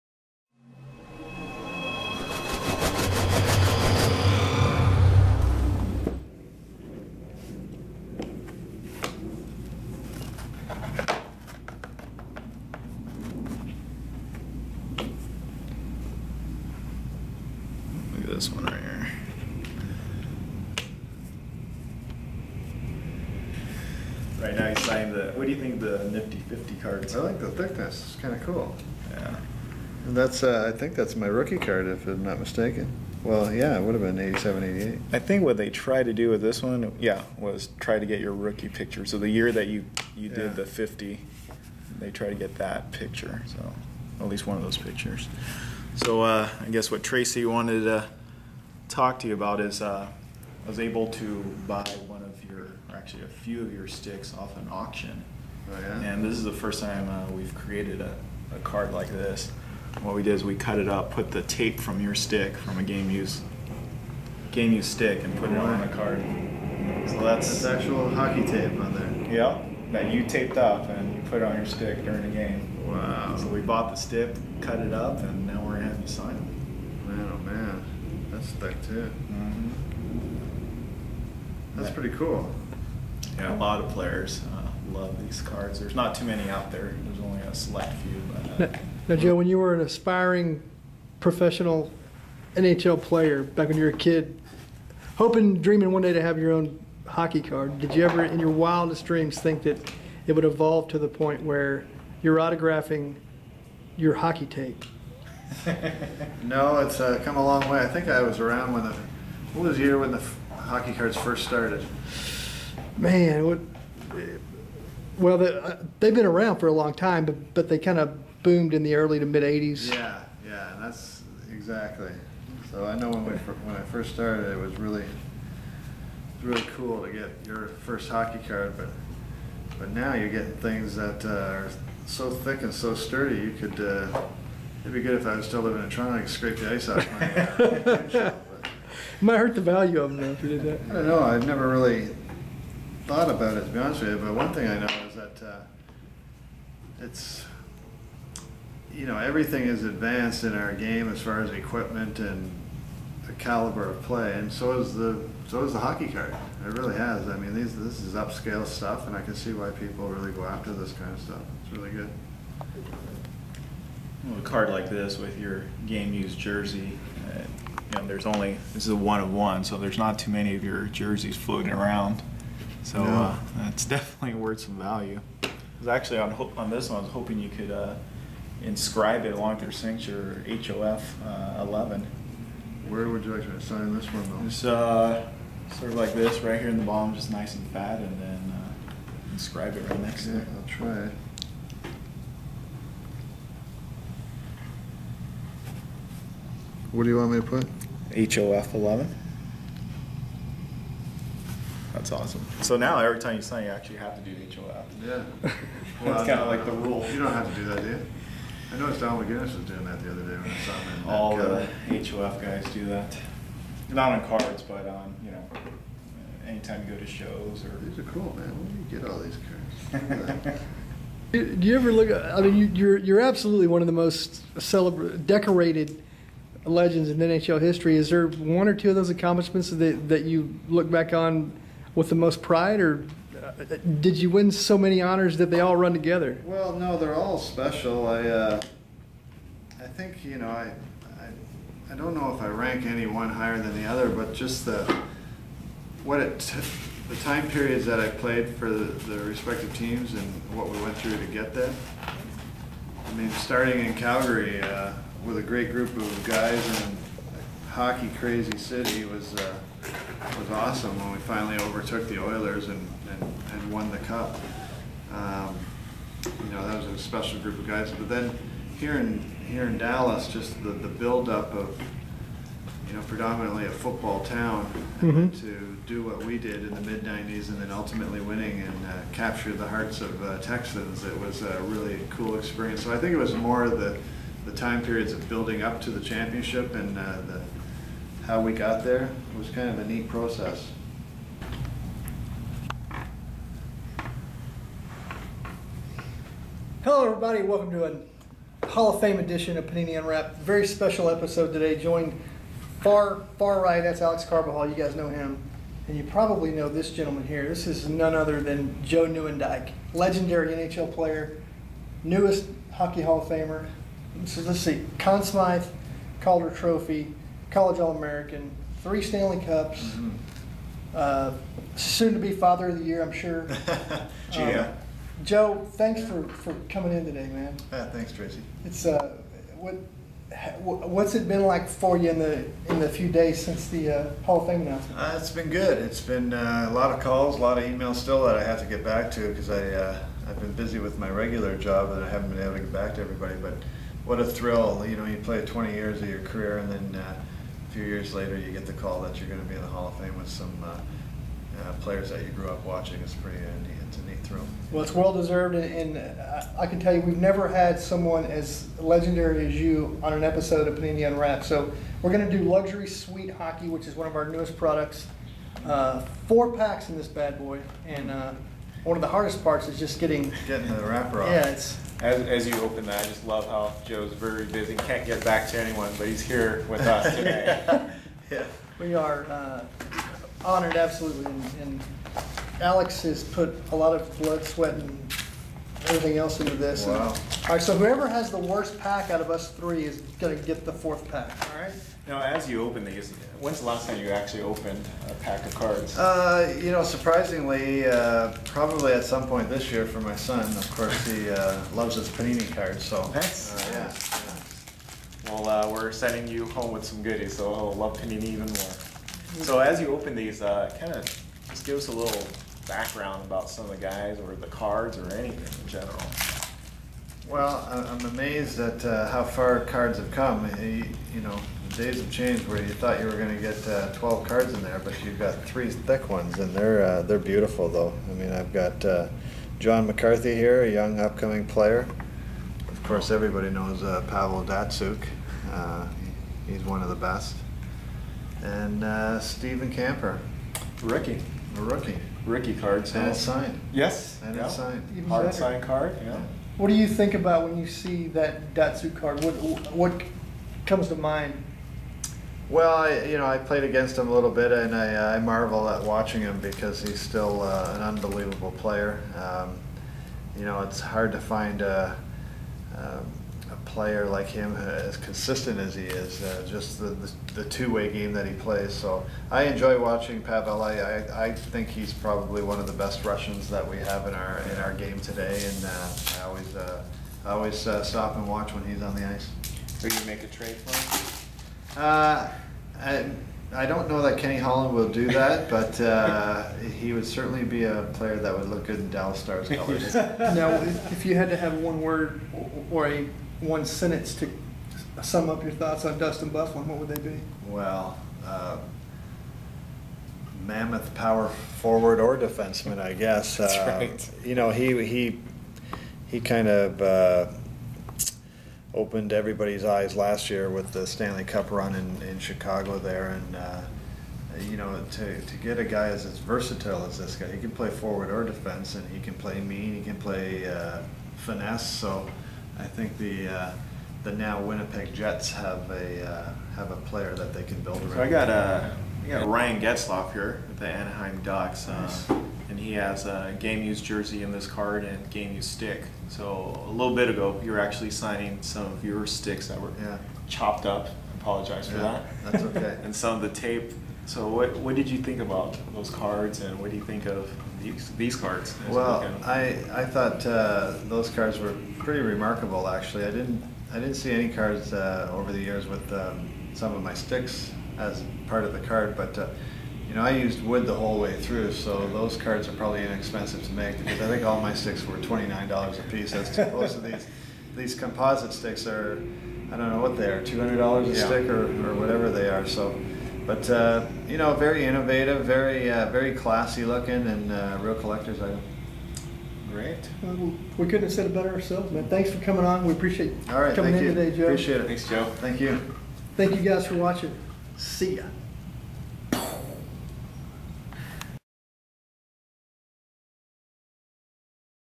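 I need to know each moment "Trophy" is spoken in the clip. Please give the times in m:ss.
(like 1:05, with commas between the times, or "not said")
5:16.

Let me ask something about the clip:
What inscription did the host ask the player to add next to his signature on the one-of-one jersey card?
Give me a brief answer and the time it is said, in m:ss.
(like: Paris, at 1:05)
HOF 11, at 3:00.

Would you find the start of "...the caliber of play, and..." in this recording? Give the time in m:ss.
2:33.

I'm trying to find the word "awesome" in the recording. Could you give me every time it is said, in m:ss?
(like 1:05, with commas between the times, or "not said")
3:22, 4:20.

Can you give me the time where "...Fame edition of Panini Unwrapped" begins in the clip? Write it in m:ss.
4:58.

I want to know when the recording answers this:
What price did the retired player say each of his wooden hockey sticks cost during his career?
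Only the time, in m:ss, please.
9:24.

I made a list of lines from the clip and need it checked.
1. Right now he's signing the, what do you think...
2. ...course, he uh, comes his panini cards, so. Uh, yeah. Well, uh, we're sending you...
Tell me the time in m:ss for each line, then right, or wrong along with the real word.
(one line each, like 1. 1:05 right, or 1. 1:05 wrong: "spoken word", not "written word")
1. 0:24 right
2. 6:40 wrong: "loves", not "comes".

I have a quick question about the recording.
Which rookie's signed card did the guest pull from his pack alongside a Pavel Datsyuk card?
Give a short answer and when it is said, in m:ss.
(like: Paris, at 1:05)
Steven Kampfer, at 7:19.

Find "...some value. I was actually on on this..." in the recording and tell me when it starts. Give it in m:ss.
2:54.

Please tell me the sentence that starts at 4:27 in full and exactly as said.
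But then here in here in Dallas, just the the buildup of you know predominantly a football town mm -hmm.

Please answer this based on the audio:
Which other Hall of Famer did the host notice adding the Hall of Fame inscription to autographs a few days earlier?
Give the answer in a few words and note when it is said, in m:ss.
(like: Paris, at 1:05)
Don McGinnis, at 3:28.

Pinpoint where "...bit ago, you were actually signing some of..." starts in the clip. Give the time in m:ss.
8:56.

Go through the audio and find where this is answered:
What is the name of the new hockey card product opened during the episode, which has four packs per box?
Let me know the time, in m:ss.
6:02.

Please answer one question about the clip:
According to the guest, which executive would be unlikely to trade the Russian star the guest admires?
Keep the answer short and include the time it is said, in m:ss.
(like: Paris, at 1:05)
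Kenny Holland, at 8:04.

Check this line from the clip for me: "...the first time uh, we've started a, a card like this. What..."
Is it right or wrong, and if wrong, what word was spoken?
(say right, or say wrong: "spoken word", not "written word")
wrong: "created", not "started".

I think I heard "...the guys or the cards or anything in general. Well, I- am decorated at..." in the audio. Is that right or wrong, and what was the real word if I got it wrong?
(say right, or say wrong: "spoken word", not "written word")
wrong: "amazed", not "decorated".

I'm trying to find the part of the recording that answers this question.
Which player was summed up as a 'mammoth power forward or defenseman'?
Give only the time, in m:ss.
8:15.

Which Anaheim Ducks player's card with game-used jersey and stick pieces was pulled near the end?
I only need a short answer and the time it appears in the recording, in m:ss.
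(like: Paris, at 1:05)
Ryan Getzlaf, at 8:49.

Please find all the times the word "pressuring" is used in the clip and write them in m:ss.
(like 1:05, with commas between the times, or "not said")
not said.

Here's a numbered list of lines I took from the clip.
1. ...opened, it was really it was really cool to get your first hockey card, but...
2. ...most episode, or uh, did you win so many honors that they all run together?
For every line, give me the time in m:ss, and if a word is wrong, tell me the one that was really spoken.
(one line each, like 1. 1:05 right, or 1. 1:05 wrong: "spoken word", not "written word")
1. 2:04 wrong: "started", not "opened"
2. 3:52 wrong: "pride", not "episode".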